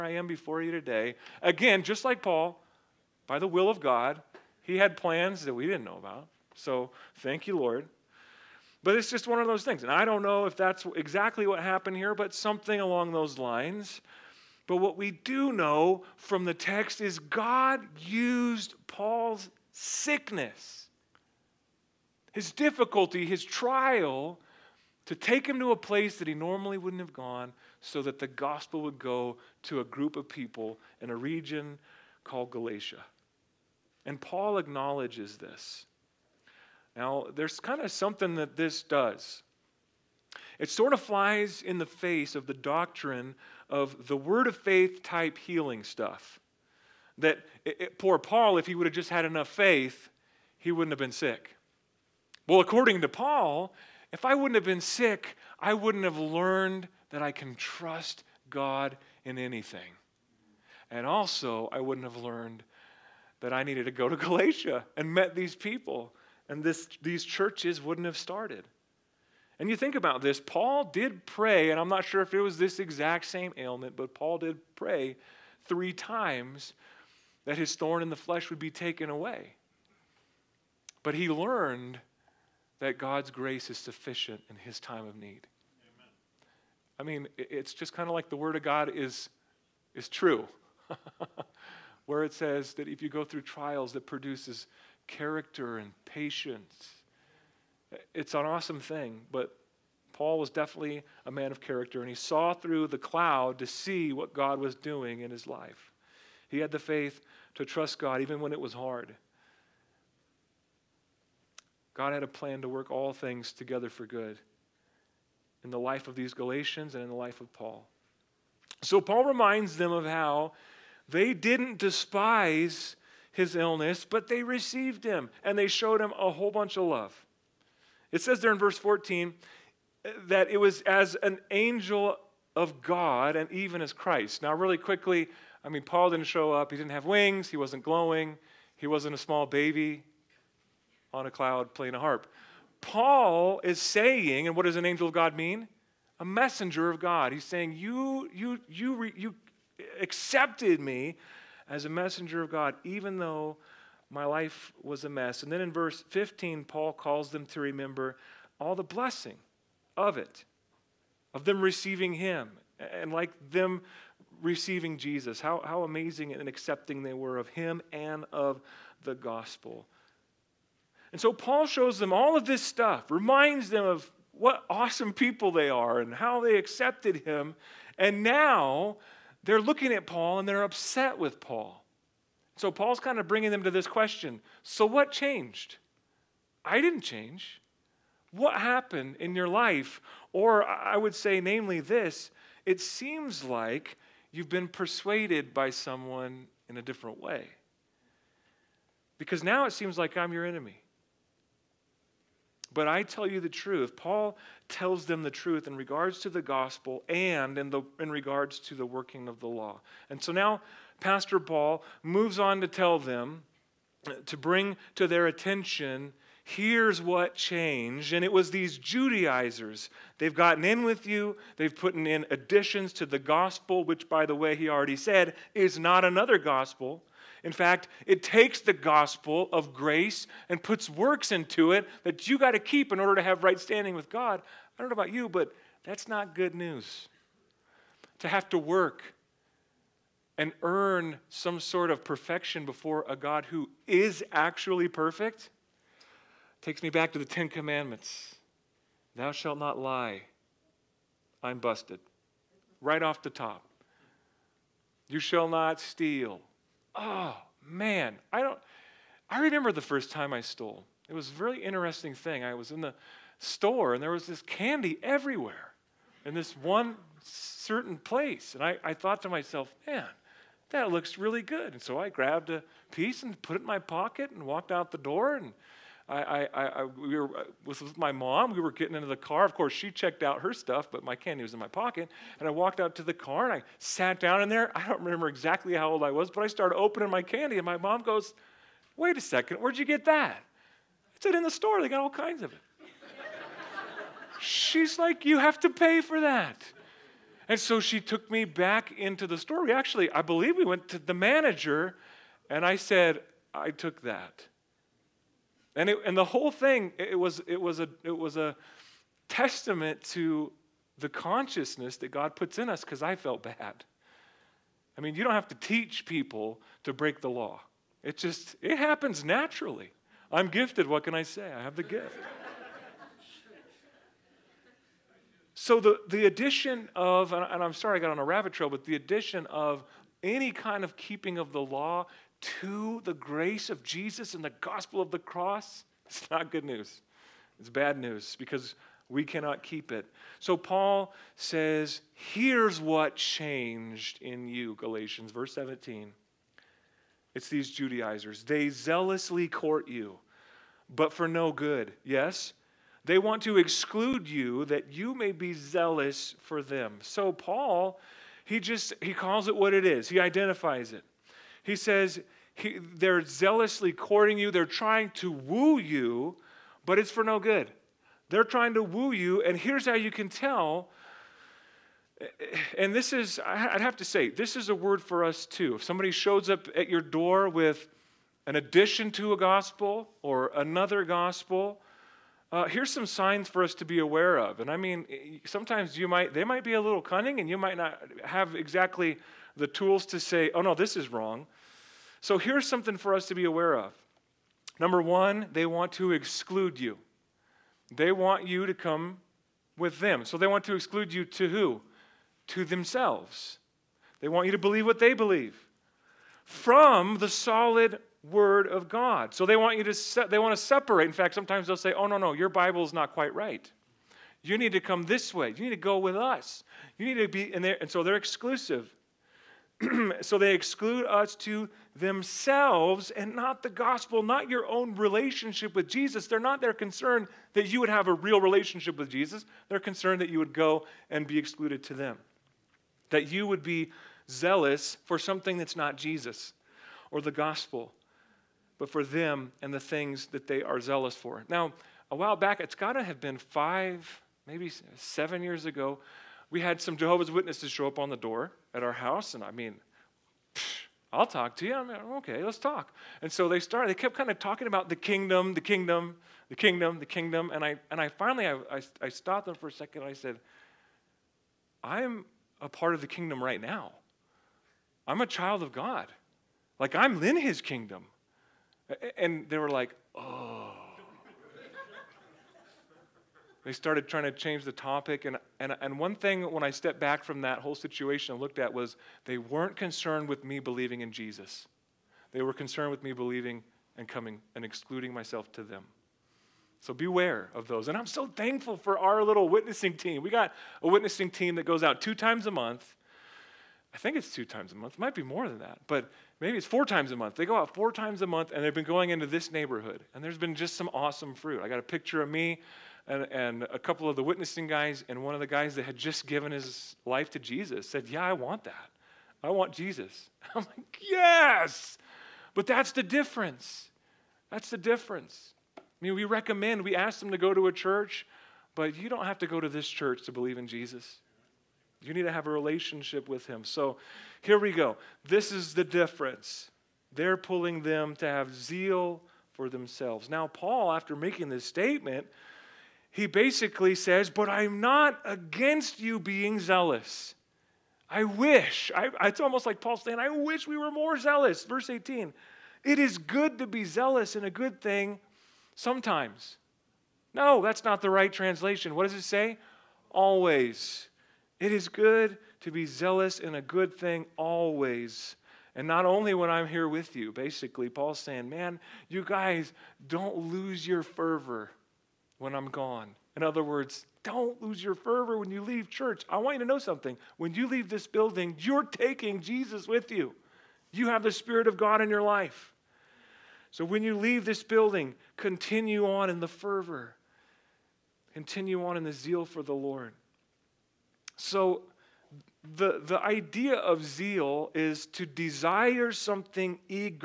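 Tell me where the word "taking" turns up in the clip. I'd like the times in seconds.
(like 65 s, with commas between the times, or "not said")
568 s.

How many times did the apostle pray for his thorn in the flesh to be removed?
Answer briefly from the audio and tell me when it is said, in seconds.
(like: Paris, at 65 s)
3, at 75 s.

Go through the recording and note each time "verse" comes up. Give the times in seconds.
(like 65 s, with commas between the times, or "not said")
128 s, 155 s, 345 s, 541 s.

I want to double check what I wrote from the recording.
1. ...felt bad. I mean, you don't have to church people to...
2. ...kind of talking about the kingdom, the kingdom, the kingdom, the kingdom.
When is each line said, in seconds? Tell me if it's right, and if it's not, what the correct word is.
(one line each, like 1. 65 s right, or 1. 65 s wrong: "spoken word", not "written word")
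1. 313 s wrong: "teach", not "church"
2. 454 s right.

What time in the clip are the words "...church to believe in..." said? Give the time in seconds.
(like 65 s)
519 s.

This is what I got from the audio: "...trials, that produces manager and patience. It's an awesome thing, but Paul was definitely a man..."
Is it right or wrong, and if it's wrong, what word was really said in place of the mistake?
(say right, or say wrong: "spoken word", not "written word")
wrong: "character", not "manager".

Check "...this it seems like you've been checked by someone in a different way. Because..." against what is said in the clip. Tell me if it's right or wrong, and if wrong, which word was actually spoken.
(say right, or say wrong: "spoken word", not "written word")
wrong: "persuaded", not "checked".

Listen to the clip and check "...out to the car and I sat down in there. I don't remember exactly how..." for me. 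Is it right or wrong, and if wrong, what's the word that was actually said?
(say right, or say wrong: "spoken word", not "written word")
right.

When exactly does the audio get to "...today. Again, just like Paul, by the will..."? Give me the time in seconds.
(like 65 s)
0 s.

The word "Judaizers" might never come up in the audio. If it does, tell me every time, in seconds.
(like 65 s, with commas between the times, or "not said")
218 s, 347 s.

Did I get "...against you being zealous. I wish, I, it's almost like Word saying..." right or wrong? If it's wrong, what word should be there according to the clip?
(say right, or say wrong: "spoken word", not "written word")
wrong: "Paul", not "Word".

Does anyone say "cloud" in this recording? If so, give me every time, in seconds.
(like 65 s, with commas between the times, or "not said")
102 s, 141 s.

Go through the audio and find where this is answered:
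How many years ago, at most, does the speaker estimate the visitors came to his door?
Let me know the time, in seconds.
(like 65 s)
444 s.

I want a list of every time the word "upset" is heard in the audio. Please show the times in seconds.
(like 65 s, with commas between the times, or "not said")
180 s.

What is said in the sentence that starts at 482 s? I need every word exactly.
They were concerned with me believing and coming and excluding myself to them.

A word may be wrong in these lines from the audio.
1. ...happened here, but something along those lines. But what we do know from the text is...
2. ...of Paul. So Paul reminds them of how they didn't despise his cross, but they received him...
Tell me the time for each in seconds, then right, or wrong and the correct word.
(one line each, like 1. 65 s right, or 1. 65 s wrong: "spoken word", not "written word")
1. 11 s right
2. 117 s wrong: "illness", not "cross".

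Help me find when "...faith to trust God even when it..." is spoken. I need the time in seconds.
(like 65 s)
106 s.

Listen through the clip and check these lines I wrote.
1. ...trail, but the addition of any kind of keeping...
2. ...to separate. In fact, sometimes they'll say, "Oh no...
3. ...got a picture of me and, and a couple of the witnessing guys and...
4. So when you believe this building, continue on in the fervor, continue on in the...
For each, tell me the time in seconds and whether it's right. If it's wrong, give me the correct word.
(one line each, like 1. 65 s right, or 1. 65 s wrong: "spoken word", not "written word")
1. 328 s right
2. 410 s right
3. 501 s right
4. 573 s wrong: "leave", not "believe".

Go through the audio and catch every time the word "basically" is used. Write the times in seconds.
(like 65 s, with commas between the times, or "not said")
533 s, 557 s.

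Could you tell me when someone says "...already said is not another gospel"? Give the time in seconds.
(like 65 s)
224 s.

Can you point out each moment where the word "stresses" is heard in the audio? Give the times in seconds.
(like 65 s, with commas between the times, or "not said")
not said.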